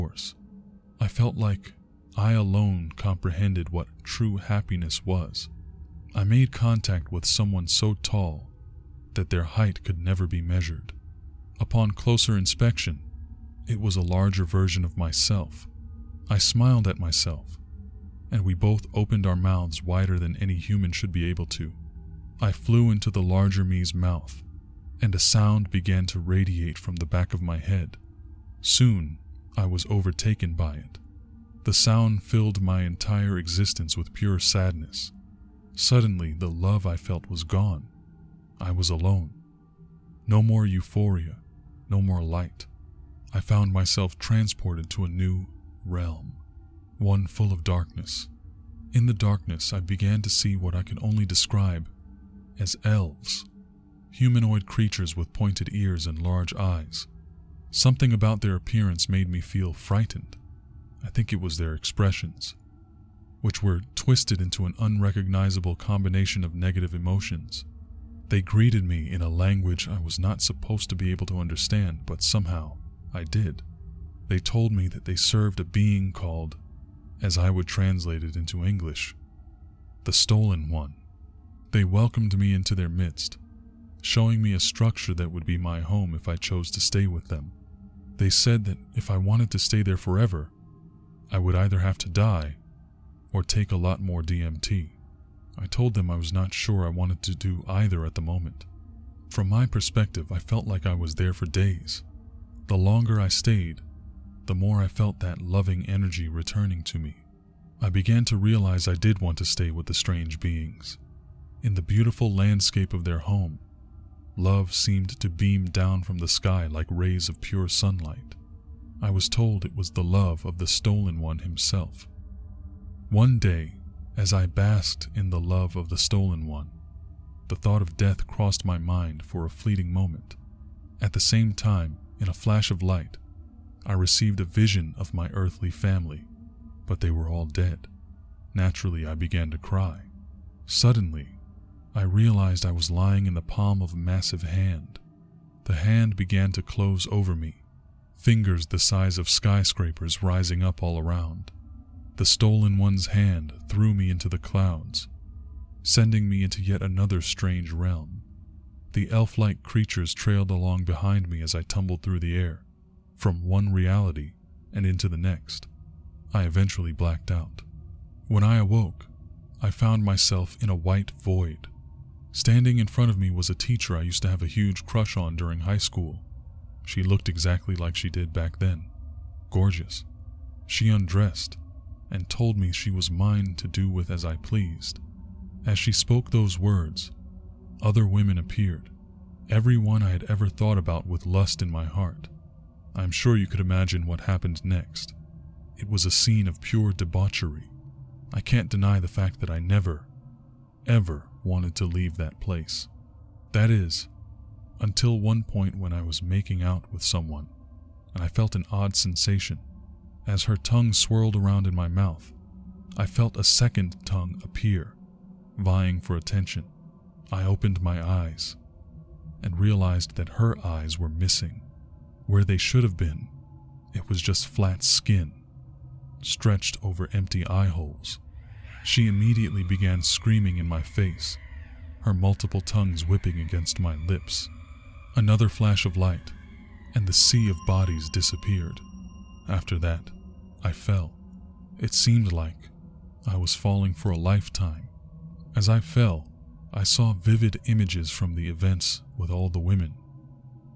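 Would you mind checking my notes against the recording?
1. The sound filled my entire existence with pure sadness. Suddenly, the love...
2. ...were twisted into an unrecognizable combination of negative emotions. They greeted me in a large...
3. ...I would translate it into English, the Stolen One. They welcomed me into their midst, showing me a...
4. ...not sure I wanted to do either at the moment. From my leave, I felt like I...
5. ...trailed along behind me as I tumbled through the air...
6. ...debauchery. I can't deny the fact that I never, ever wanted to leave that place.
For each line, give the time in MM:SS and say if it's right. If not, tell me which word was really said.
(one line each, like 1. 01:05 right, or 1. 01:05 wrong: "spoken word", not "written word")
1. 00:31 right
2. 01:03 wrong: "language", not "large"
3. 01:17 right
4. 01:36 wrong: "perspective", not "leave"
5. 02:40 right
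6. 03:16 right.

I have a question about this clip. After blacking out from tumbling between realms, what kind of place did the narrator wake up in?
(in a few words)
a white void.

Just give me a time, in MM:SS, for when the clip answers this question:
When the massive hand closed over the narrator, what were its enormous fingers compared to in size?
02:29.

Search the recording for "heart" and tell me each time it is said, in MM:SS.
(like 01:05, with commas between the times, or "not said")
03:11.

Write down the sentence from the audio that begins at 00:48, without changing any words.
In the darkness, I began to see what I could only describe as elves, humanoid creatures with pointed ears and large eyes.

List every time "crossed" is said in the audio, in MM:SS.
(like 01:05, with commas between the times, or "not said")
02:08.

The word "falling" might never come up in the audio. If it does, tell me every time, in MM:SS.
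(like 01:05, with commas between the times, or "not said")
04:03.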